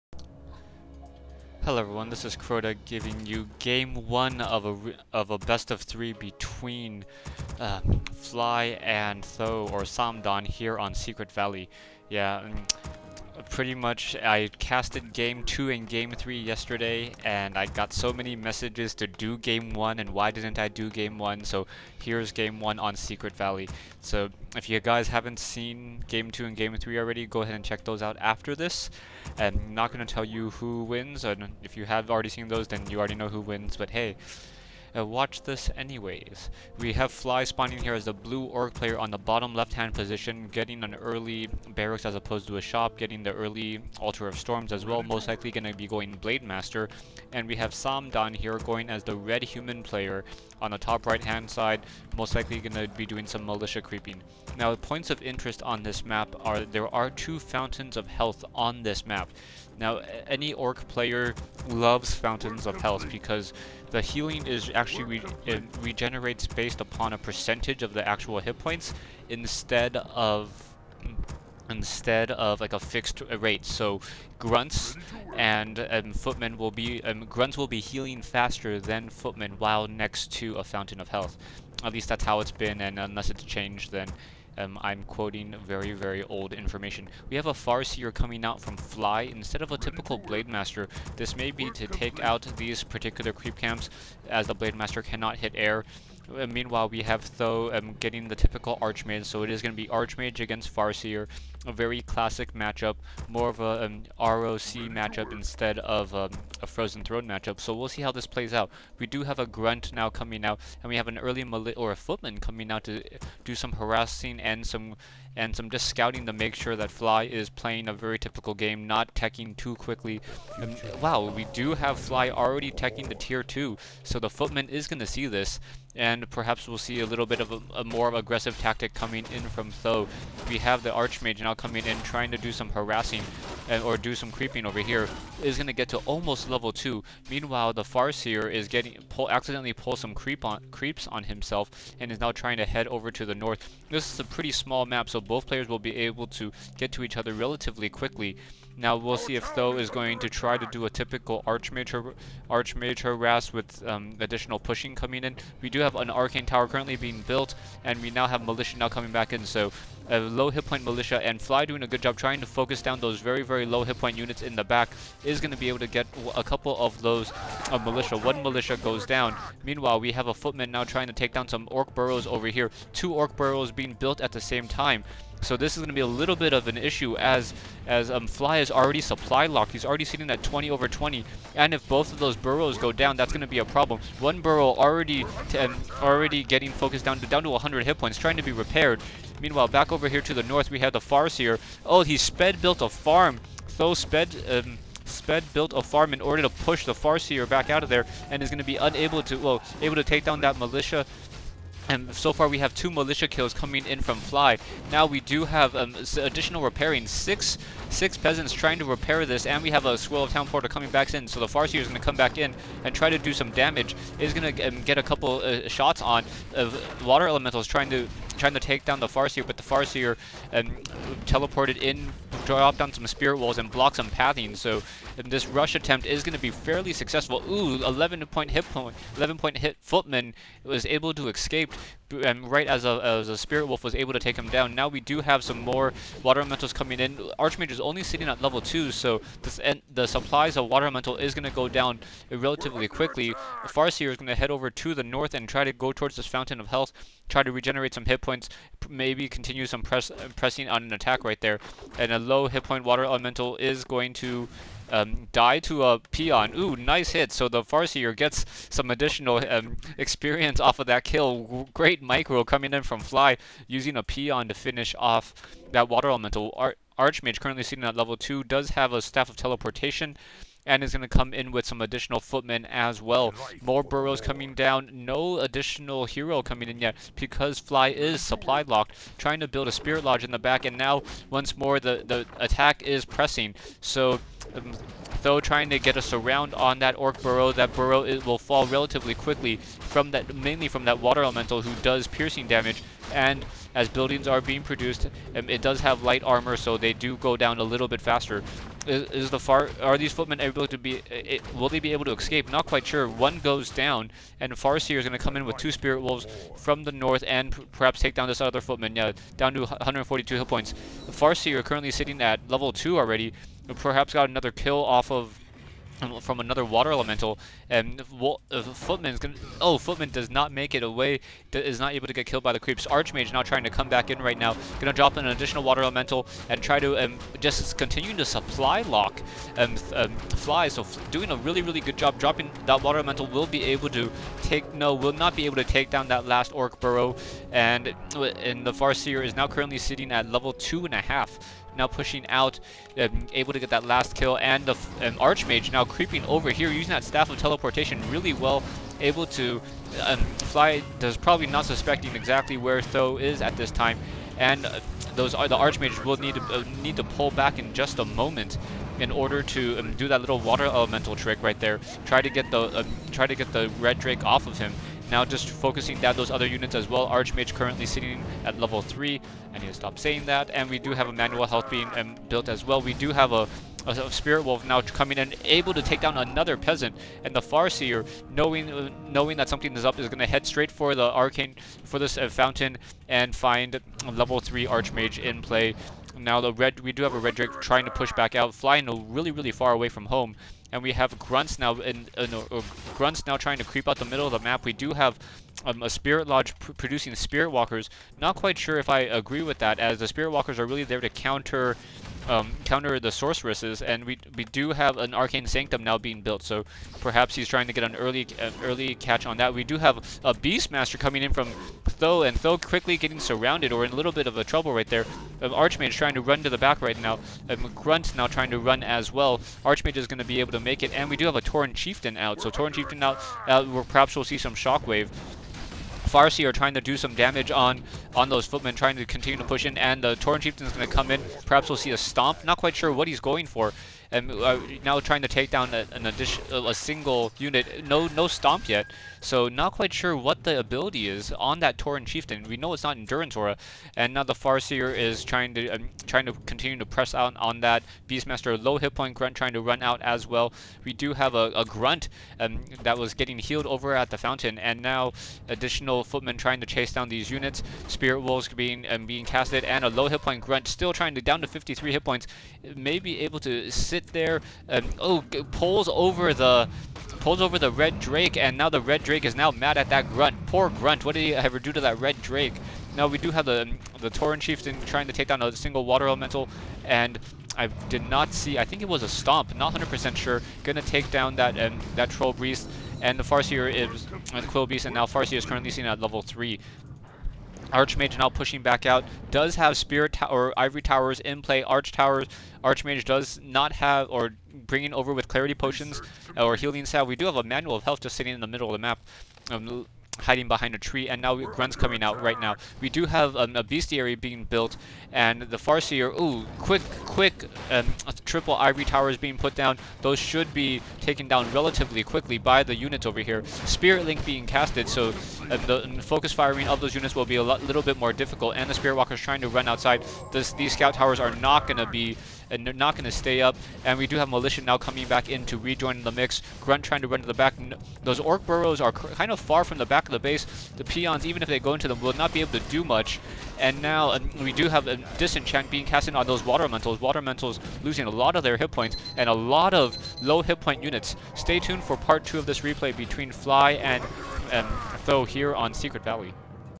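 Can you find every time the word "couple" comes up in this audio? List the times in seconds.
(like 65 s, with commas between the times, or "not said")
166 s, 215 s.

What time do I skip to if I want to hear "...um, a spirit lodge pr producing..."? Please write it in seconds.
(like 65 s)
395 s.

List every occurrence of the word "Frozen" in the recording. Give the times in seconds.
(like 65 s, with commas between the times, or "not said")
106 s.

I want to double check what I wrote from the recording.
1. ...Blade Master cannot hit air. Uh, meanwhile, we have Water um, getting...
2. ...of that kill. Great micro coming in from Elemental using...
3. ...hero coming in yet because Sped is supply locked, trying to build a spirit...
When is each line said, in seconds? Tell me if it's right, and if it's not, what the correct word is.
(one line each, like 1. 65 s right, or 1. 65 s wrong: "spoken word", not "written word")
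1. 94 s wrong: "Tho", not "Water"
2. 260 s wrong: "Fly", not "Elemental"
3. 276 s wrong: "Fly", not "Sped".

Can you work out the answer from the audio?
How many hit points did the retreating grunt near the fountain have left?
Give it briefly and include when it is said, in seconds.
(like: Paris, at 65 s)
53, at 461 s.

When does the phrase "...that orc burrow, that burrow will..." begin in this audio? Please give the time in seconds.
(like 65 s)
286 s.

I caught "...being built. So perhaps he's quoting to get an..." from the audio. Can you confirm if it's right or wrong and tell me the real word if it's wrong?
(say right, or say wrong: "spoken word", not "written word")
wrong: "trying", not "quoting".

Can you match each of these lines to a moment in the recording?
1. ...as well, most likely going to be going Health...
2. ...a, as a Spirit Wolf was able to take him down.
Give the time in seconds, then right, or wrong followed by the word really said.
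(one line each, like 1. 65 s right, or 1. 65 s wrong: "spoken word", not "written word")
1. 44 s wrong: "Blade", not "Health"
2. 232 s right.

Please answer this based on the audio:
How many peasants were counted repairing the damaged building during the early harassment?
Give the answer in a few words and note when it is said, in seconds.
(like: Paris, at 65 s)
6, at 207 s.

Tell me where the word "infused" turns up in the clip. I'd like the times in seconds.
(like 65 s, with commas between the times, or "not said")
not said.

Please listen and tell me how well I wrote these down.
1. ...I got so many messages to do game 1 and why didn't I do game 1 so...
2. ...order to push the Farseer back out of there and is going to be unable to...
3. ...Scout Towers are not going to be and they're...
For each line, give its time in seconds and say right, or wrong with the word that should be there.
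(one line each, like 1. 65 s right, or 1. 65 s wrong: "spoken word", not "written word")
1. 17 s right
2. 196 s right
3. 520 s right.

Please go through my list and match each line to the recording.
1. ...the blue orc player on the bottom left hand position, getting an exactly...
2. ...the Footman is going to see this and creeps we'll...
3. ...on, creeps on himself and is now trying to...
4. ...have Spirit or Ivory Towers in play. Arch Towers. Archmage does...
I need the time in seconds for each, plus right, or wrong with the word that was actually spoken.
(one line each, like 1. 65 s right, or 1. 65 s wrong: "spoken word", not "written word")
1. 38 s wrong: "early", not "exactly"
2. 124 s wrong: "perhaps", not "creeps"
3. 140 s right
4. 489 s right.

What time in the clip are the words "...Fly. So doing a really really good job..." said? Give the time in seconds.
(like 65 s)
330 s.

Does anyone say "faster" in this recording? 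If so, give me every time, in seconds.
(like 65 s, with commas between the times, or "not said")
78 s, 298 s.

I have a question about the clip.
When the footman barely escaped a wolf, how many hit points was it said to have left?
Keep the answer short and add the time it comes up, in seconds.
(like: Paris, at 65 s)
11, at 229 s.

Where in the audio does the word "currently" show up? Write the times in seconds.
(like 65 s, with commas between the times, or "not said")
156 s, 267 s, 311 s, 339 s, 367 s, 485 s.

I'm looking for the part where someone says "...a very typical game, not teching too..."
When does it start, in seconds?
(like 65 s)
117 s.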